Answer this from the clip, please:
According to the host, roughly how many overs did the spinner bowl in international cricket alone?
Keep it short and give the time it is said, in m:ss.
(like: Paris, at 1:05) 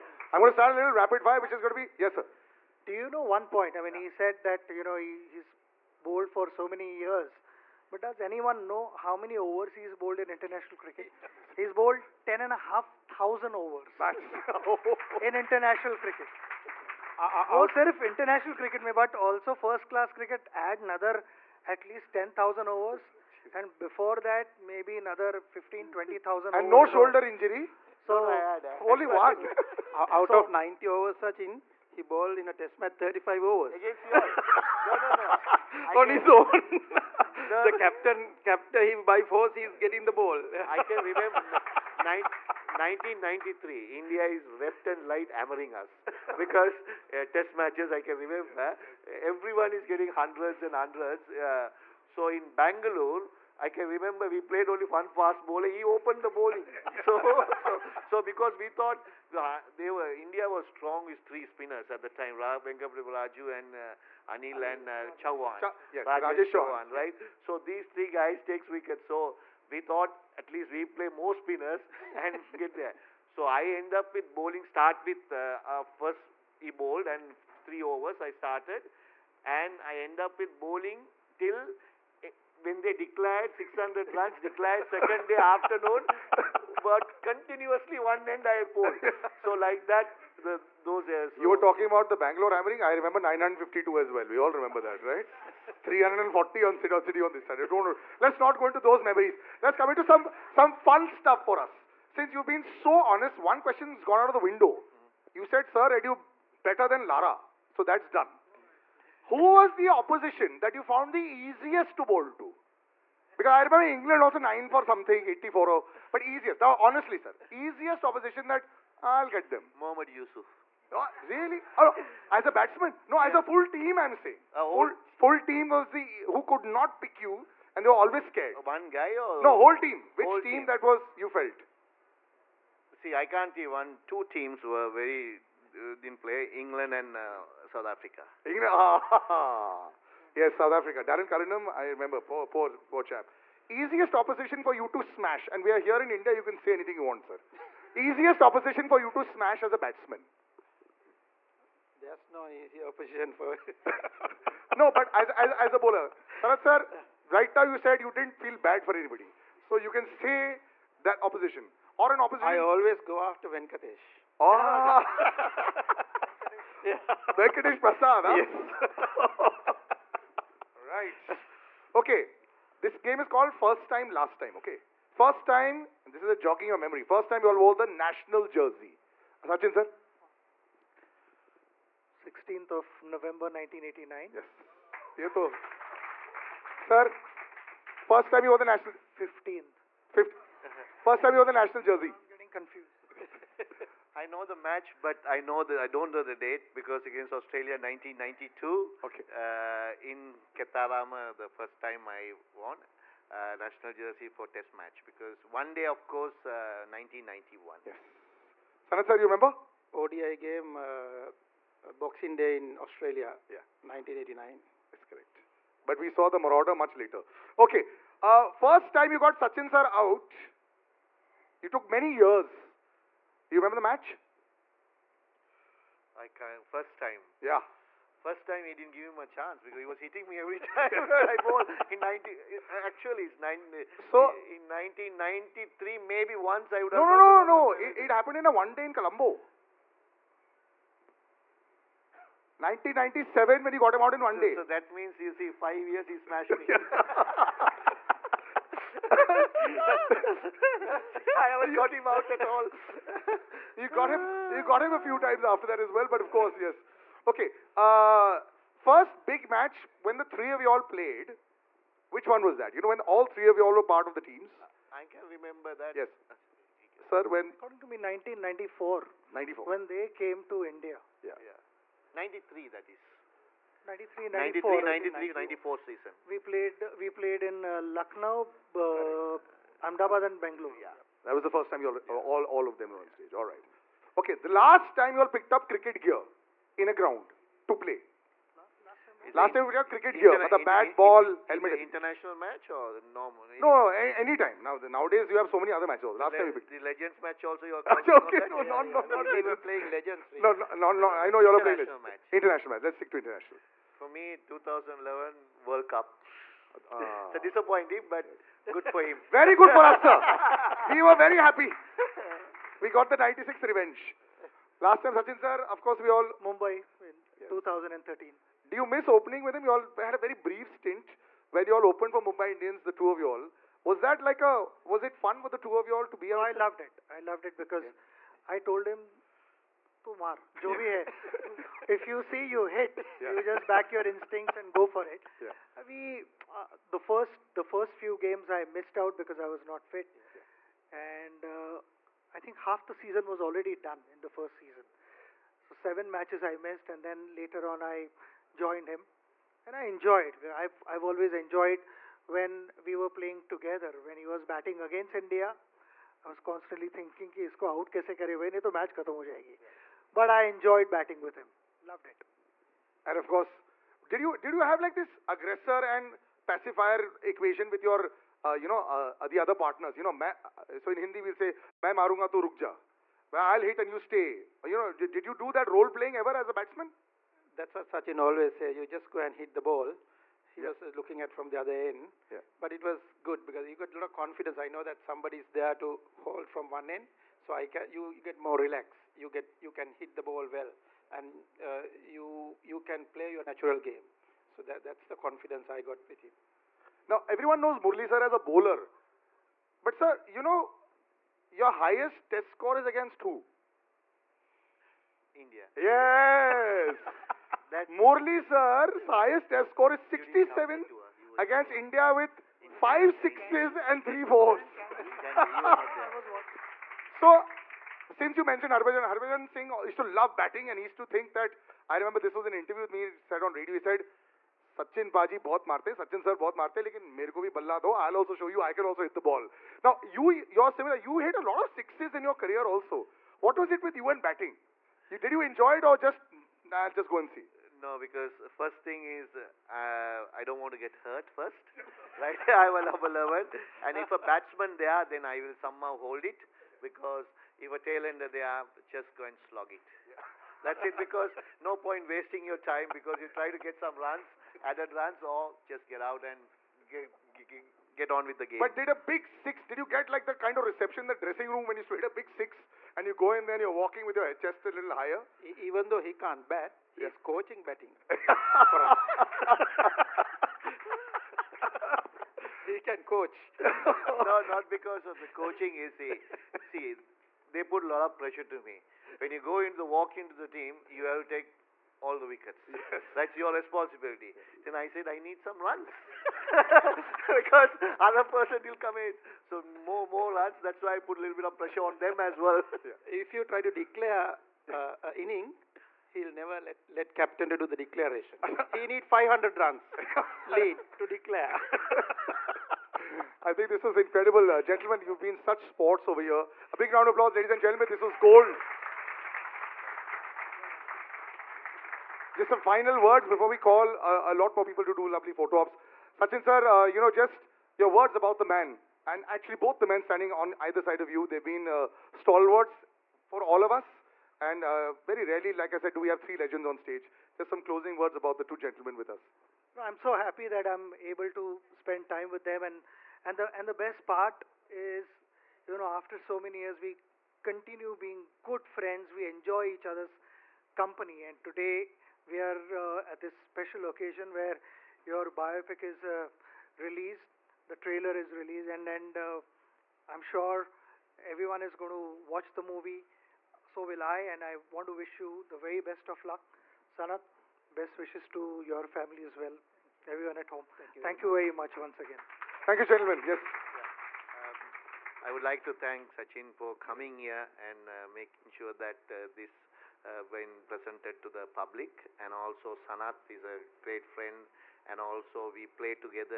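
10,500, at 0:12.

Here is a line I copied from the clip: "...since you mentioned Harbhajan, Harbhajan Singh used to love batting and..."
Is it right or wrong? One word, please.
right.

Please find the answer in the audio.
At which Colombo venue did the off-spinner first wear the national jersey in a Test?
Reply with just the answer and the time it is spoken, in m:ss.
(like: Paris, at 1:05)
Khettarama, at 3:20.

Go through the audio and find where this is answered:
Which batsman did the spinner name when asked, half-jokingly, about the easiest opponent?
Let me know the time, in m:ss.
1:59.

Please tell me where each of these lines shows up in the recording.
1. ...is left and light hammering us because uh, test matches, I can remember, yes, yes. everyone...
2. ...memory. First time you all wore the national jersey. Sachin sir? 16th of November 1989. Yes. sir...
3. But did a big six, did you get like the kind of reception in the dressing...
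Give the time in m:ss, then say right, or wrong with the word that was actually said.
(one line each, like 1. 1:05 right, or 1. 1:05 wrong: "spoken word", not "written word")
1. 0:44 right
2. 2:56 right
3. 7:38 right.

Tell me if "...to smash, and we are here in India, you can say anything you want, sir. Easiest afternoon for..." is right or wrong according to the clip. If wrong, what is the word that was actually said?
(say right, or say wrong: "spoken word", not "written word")
wrong: "opposition", not "afternoon".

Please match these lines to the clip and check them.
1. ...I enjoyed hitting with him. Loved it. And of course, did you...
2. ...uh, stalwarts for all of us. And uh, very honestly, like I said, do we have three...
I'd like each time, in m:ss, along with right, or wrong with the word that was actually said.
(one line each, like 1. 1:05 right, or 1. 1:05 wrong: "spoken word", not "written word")
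1. 6:00 wrong: "batting", not "hitting"
2. 8:41 wrong: "rarely", not "honestly".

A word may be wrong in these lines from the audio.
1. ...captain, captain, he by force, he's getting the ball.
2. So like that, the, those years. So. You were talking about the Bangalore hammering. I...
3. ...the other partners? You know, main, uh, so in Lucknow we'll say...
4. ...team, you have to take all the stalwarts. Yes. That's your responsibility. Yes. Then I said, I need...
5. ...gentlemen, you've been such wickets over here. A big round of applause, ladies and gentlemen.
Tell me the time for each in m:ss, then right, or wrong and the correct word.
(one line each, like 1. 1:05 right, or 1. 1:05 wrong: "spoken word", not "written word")
1. 0:37 right
2. 1:29 right
3. 6:09 wrong: "Hindi", not "Lucknow"
4. 8:00 wrong: "wickets", not "stalwarts"
5. 8:24 wrong: "sports", not "wickets".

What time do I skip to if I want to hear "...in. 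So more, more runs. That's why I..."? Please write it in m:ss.
8:08.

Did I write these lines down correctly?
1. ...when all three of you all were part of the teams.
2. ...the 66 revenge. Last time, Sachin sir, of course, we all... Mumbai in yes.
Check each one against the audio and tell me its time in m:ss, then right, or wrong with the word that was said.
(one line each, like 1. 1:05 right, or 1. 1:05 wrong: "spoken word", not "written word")
1. 4:22 right
2. 5:13 wrong: "96", not "66".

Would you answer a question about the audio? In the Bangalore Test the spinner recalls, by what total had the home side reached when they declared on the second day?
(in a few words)
600 runs.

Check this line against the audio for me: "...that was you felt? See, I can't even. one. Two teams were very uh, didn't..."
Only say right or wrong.
right.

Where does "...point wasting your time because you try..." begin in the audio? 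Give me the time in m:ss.
7:31.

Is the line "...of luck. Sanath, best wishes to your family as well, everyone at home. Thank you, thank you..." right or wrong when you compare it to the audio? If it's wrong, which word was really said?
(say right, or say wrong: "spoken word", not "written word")
right.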